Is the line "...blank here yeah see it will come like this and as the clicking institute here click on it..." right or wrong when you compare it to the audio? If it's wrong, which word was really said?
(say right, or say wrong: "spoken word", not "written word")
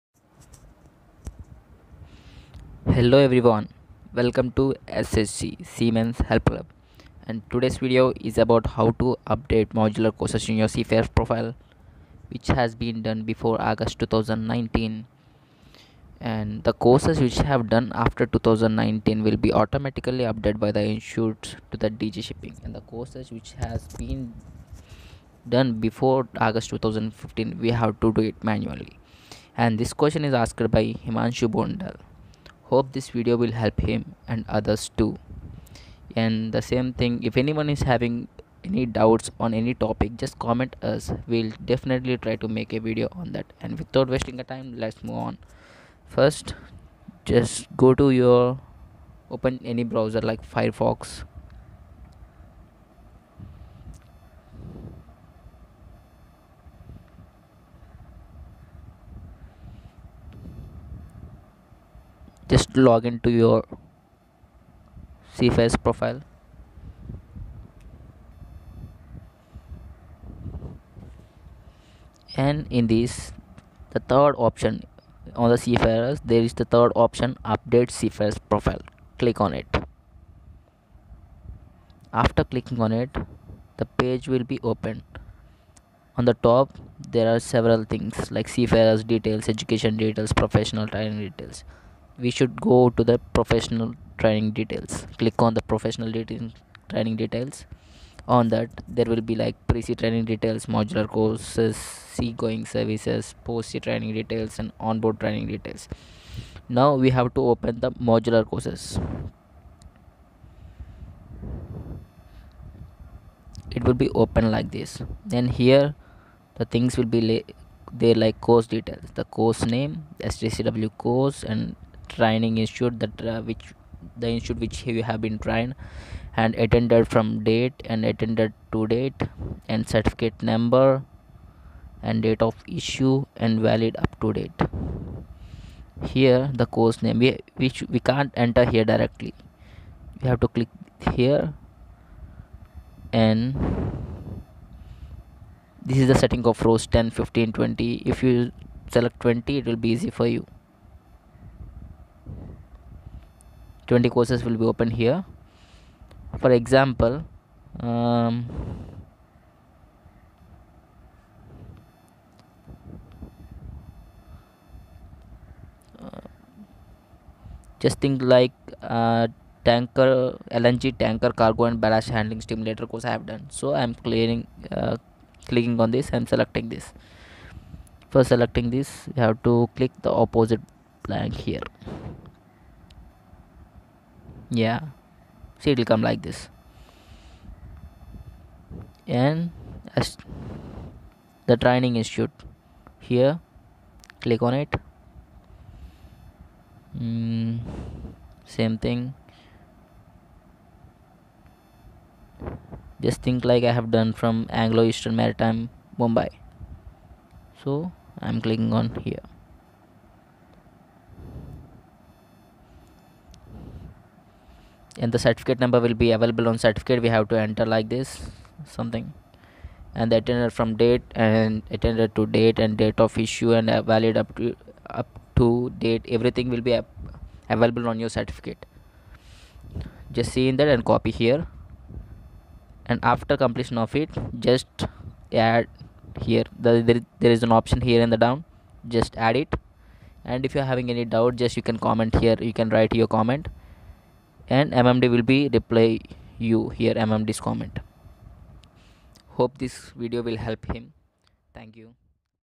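wrong: "training", not "clicking".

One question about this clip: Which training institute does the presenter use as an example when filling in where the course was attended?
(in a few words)
Anglo Eastern Maritime Mumbai.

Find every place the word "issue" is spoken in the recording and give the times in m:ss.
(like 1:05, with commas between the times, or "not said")
2:12, 3:43.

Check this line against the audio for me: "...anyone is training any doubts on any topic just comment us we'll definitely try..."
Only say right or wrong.
wrong.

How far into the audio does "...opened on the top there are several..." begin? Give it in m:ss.
1:24.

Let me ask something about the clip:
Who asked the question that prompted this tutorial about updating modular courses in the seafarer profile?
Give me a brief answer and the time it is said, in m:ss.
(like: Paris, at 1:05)
Himanshu Bondal, at 0:31.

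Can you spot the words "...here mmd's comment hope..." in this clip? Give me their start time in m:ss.
4:06.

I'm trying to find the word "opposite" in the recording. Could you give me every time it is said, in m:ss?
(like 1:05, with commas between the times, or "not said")
3:00.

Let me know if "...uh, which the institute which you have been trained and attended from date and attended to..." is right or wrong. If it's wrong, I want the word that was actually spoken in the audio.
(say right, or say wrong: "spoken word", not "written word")
right.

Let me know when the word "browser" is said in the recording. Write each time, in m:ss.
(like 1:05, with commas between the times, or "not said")
0:49.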